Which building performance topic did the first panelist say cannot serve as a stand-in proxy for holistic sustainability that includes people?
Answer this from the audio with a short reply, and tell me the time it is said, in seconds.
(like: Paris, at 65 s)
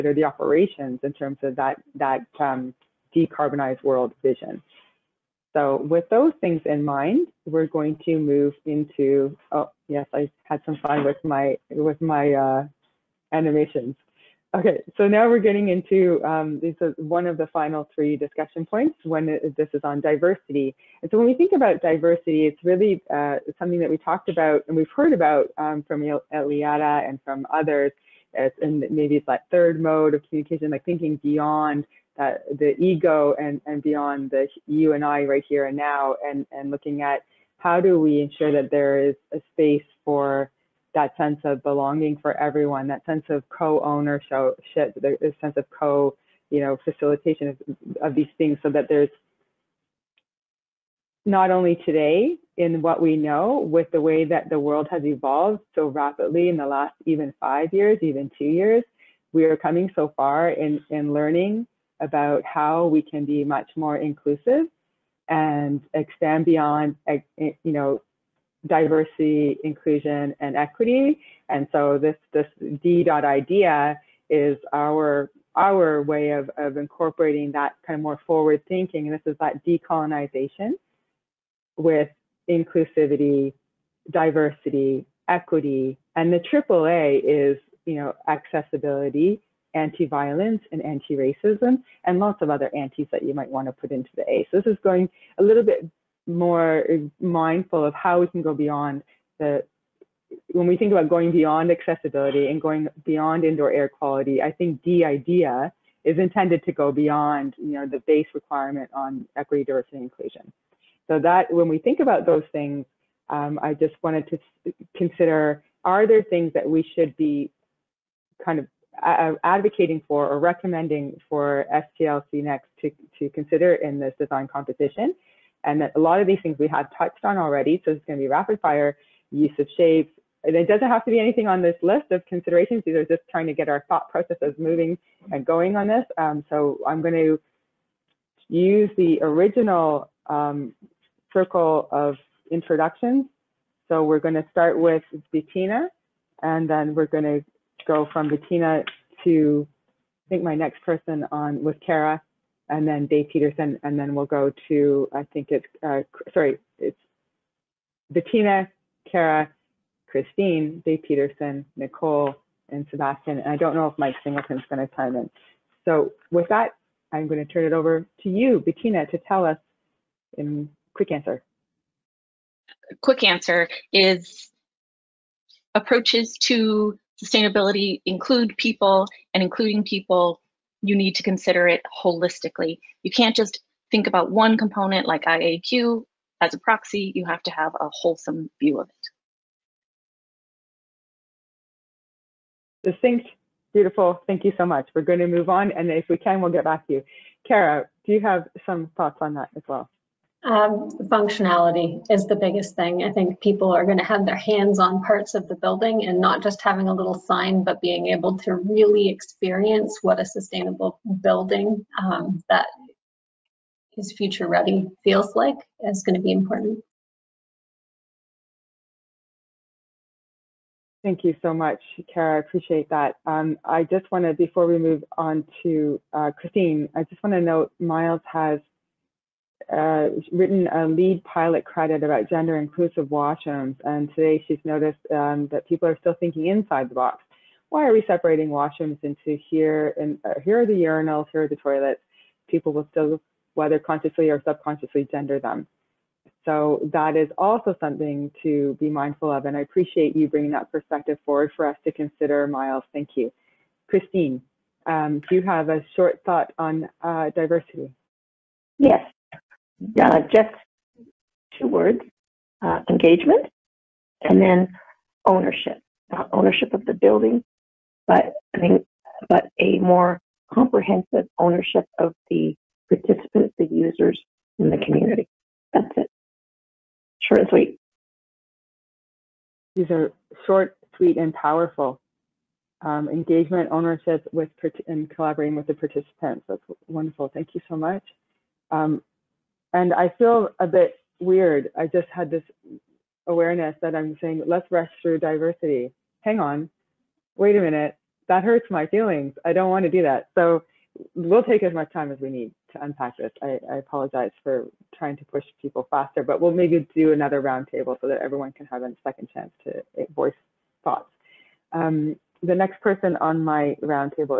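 IAQ, at 185 s.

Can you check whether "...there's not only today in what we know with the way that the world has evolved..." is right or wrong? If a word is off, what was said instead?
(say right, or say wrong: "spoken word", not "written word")
right.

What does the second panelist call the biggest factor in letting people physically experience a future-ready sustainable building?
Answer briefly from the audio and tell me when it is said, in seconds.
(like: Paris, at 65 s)
functionality, at 201 s.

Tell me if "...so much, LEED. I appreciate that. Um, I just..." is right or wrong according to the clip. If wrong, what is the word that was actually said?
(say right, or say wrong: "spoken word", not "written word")
wrong: "Kara", not "LEED".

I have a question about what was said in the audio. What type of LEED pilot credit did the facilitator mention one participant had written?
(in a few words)
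gender inclusive washrooms.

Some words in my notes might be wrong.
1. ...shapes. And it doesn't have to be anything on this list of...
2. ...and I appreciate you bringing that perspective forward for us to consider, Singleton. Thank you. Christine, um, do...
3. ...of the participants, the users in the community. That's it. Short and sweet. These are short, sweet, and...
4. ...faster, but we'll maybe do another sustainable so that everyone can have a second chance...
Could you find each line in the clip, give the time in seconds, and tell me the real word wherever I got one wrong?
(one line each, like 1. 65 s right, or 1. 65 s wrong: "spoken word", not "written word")
1. 129 s right
2. 249 s wrong: "Miles", not "Singleton"
3. 271 s right
4. 305 s wrong: "roundtable", not "sustainable".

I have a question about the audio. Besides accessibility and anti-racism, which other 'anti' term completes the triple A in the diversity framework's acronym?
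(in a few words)
anti-violence.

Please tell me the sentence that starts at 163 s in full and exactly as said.
And I don't know if Mike Singleton's going to chime in.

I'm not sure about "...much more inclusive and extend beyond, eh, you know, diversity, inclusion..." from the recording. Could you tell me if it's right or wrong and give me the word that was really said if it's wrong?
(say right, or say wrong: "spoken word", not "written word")
right.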